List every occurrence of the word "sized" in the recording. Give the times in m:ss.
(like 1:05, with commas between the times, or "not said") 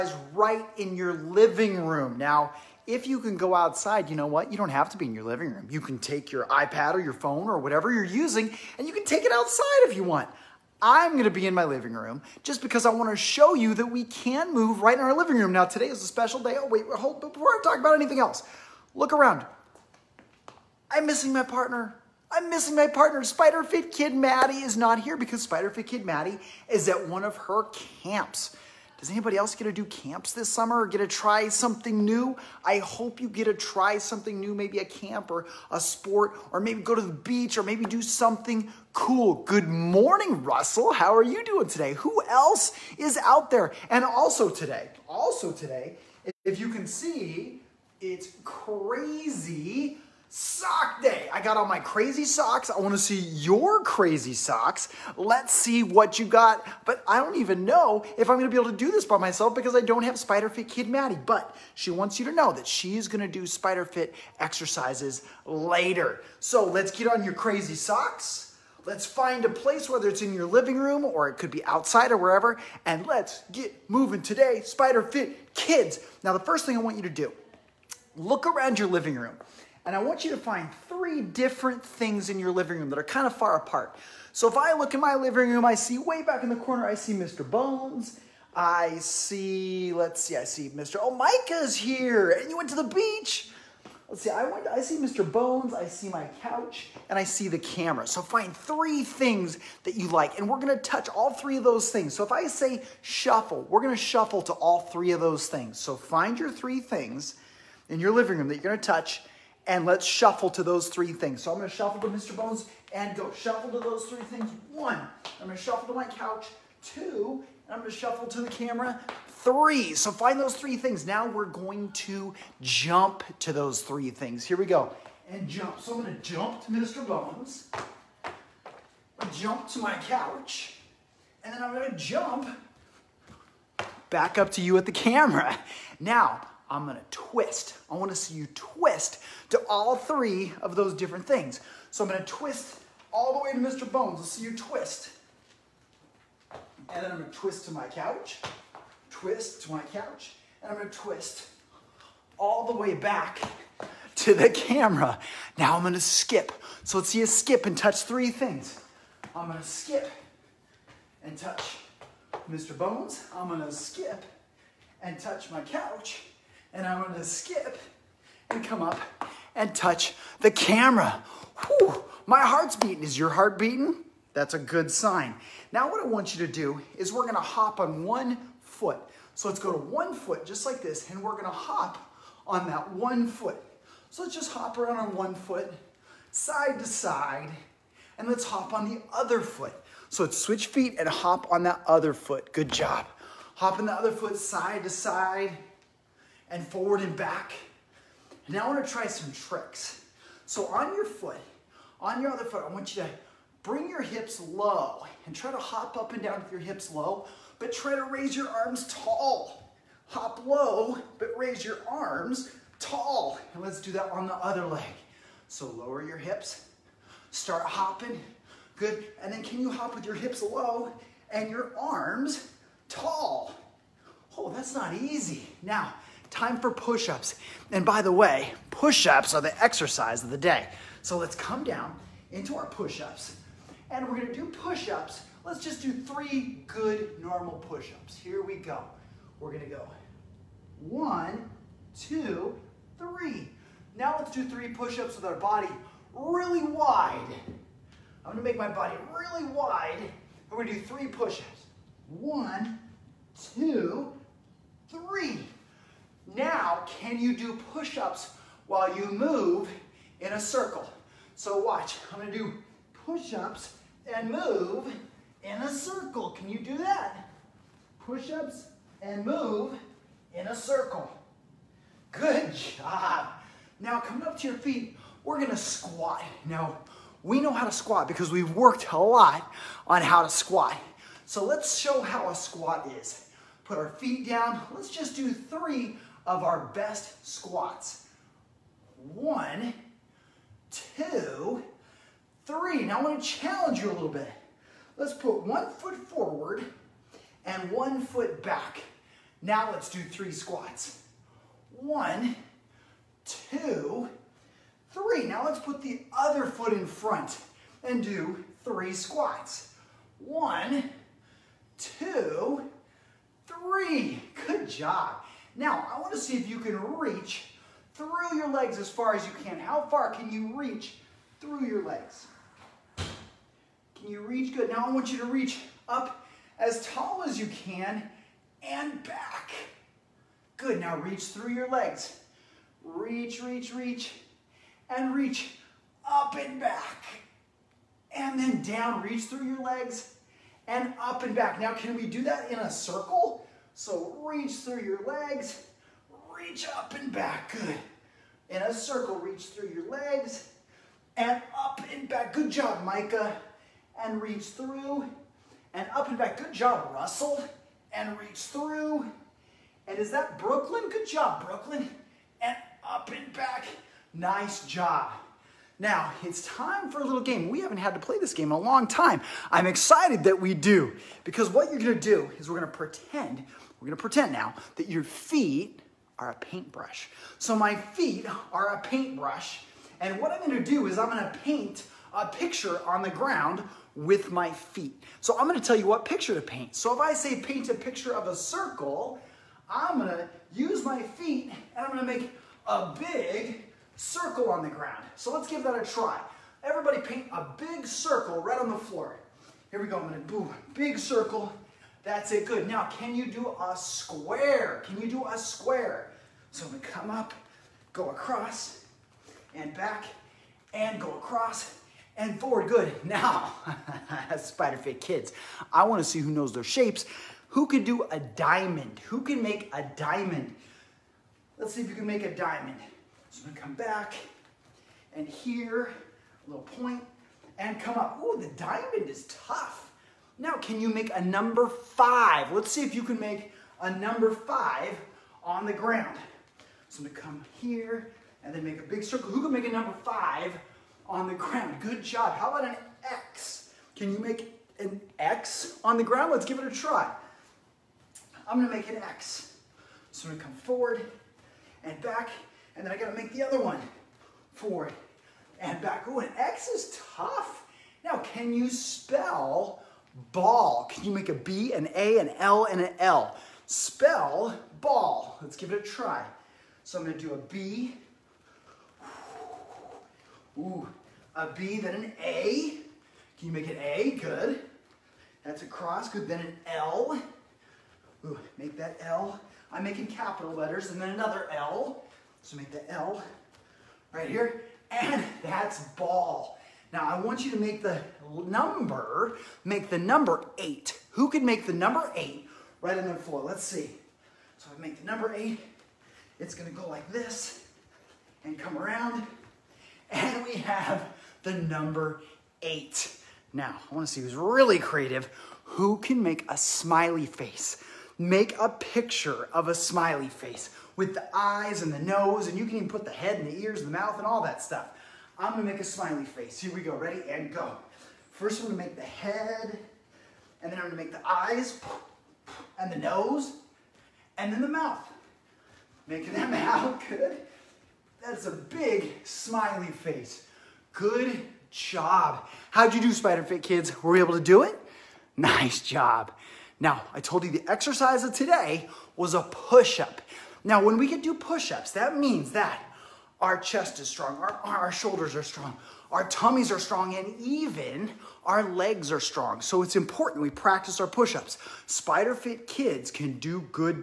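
not said.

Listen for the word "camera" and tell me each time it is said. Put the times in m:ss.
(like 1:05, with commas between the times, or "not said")
1:37, 1:58, 2:14, 2:34, 2:50.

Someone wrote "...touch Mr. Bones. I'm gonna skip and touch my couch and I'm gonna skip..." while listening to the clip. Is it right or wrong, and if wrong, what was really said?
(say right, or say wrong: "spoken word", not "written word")
right.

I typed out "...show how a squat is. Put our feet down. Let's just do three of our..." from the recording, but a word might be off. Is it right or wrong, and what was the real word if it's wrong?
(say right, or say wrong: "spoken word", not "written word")
right.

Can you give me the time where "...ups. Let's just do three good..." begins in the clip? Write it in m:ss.
3:54.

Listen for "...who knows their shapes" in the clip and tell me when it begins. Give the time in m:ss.
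6:56.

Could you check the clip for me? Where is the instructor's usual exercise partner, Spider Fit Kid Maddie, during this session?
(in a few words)
At one of her camps.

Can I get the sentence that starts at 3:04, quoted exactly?
So let's just hop around on one foot, side to side, and let's hop on the other foot.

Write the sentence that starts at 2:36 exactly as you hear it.
So let's see you skip and touch three things.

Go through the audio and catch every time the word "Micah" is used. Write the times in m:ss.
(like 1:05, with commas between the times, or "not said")
1:31, 5:52.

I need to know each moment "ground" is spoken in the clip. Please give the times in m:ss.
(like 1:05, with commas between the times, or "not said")
6:23, 6:34, 7:15, 7:21, 7:26.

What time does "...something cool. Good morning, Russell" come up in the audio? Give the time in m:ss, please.
0:38.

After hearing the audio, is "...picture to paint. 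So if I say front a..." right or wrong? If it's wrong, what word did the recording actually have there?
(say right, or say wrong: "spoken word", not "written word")
wrong: "paint", not "front".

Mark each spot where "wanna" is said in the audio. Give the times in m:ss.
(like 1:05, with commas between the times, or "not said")
0:12, 2:17, 3:18, 6:55, 8:23.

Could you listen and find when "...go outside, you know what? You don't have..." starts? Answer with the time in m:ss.
0:03.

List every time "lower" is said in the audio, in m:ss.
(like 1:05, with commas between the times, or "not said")
3:35.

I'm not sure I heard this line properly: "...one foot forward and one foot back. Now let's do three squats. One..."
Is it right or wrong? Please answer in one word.
right.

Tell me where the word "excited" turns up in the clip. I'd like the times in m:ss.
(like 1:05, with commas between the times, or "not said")
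6:09.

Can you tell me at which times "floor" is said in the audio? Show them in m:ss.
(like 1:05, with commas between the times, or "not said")
6:38, 8:13.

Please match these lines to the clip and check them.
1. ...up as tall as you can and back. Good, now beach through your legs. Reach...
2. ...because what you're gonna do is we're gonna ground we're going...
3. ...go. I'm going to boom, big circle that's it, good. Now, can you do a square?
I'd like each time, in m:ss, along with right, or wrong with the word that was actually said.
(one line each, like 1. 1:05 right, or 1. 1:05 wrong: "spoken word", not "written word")
1. 5:25 wrong: "reach", not "beach"
2. 6:11 wrong: "pretend", not "ground"
3. 6:39 right.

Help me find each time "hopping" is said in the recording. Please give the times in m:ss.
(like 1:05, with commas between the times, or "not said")
3:37.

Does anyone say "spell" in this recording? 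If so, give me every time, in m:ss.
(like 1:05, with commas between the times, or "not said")
7:38, 7:43.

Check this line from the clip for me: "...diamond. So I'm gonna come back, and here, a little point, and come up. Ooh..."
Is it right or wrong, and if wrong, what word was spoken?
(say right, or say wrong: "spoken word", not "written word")
right.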